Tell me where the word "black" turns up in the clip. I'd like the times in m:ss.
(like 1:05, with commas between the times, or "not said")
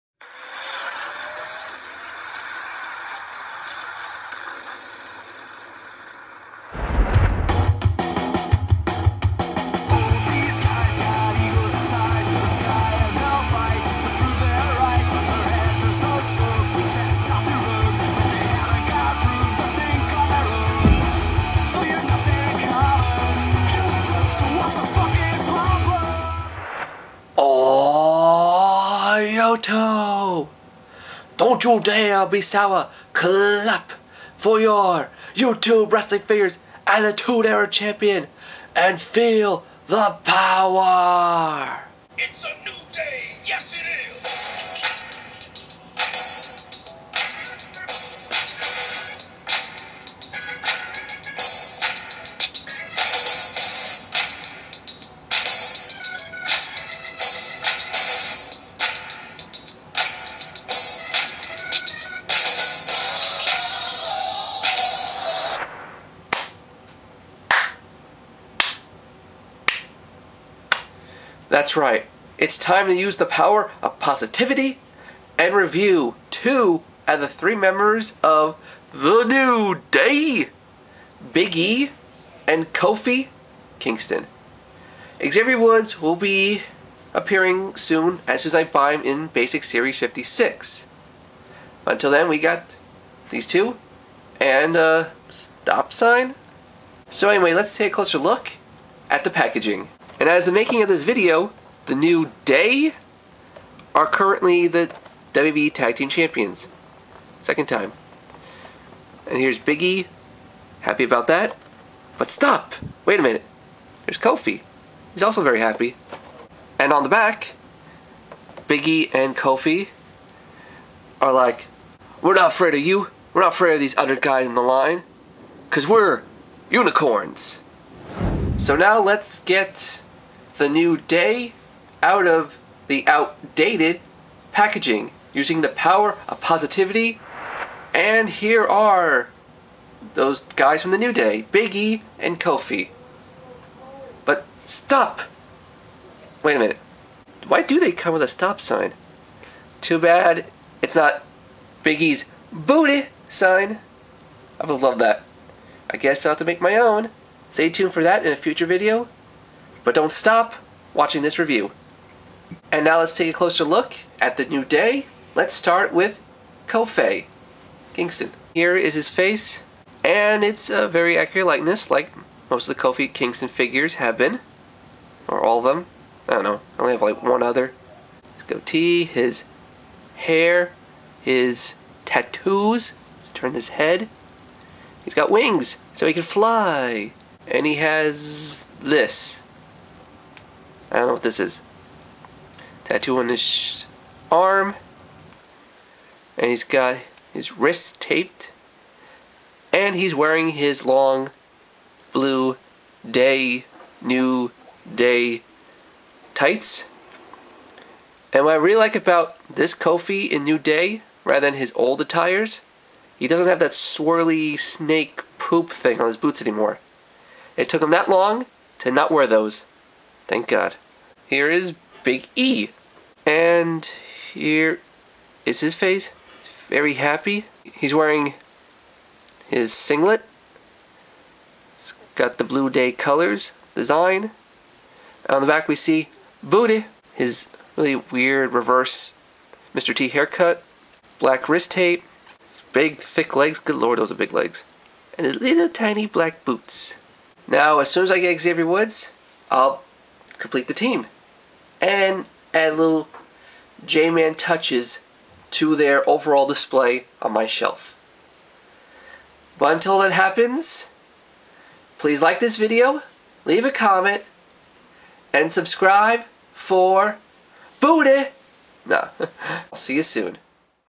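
4:01, 4:06.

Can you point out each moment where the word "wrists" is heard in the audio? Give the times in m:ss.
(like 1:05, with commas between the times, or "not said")
3:17, 4:01.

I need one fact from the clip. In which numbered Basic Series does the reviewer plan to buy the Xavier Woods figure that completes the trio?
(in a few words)
56.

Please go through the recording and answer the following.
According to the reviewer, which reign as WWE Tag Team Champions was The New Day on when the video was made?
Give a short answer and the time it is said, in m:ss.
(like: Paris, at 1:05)
Second time, at 1:47.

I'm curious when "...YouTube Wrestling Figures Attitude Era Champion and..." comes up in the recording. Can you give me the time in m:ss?
0:35.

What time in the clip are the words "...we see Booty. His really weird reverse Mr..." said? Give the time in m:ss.
3:55.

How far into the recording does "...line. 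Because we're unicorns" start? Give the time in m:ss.
2:04.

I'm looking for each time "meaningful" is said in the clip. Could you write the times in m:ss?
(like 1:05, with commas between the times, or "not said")
not said.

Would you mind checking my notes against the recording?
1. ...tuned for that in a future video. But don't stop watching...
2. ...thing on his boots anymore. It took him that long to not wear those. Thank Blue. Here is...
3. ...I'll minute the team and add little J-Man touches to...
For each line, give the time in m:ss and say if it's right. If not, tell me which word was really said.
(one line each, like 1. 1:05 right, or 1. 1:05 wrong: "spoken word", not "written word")
1. 2:37 right
2. 3:35 wrong: "God", not "Blue"
3. 4:09 wrong: "complete", not "minute".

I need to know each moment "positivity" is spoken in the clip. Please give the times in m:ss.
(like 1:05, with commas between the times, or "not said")
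1:13, 2:16.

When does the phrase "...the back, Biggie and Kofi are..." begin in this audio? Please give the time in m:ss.
1:57.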